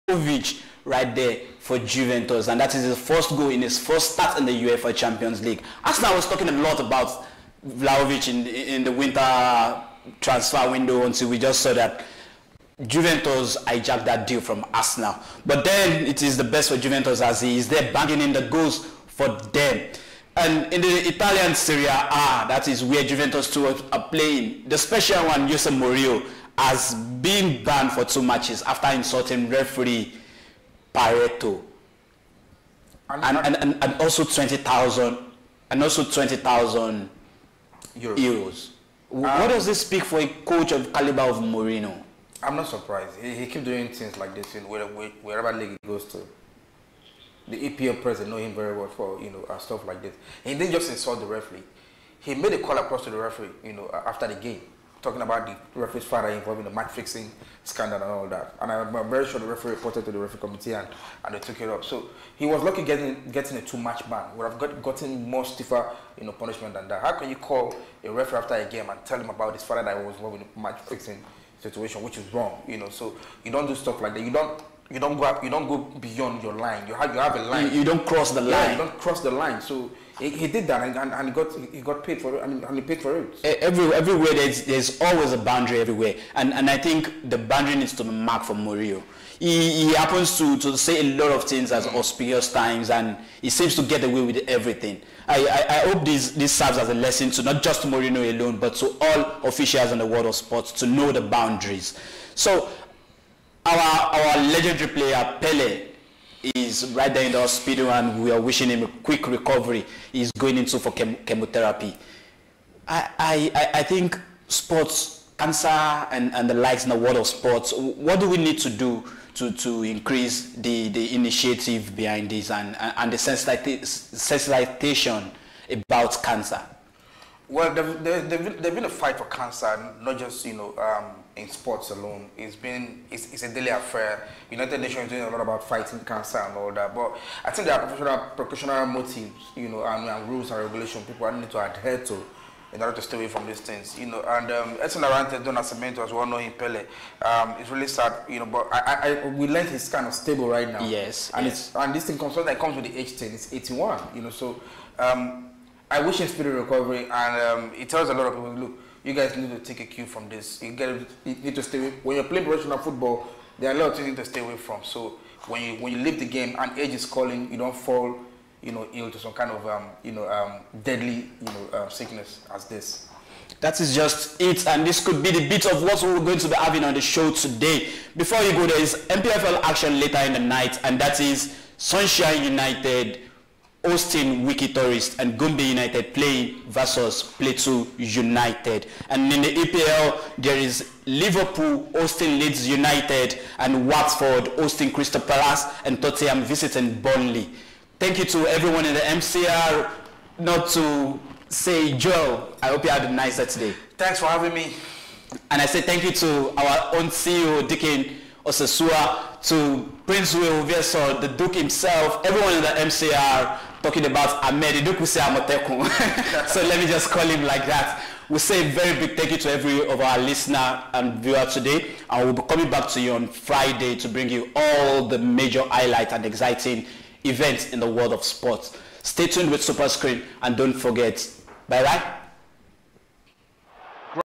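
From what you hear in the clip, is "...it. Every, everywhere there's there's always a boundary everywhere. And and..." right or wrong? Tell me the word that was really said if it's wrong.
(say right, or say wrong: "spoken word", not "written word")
right.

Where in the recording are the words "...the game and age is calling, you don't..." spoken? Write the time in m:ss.
2:46.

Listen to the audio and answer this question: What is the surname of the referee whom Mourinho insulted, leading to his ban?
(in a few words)
Pairetto.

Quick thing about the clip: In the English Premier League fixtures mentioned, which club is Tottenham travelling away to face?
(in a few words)
Burnley.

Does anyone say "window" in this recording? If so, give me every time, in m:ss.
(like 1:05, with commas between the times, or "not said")
0:10.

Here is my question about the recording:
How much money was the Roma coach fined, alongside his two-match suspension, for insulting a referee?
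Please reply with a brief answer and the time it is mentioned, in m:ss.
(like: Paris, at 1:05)
20,000 euros, at 0:36.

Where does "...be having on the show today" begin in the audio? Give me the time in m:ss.
2:56.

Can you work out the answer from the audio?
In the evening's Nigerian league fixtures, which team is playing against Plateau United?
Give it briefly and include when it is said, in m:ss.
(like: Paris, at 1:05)
Gombe United, at 3:05.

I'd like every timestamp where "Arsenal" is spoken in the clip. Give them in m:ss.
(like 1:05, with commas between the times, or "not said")
0:05, 0:14.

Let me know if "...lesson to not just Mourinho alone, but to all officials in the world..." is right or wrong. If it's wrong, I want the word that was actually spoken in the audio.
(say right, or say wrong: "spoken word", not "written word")
right.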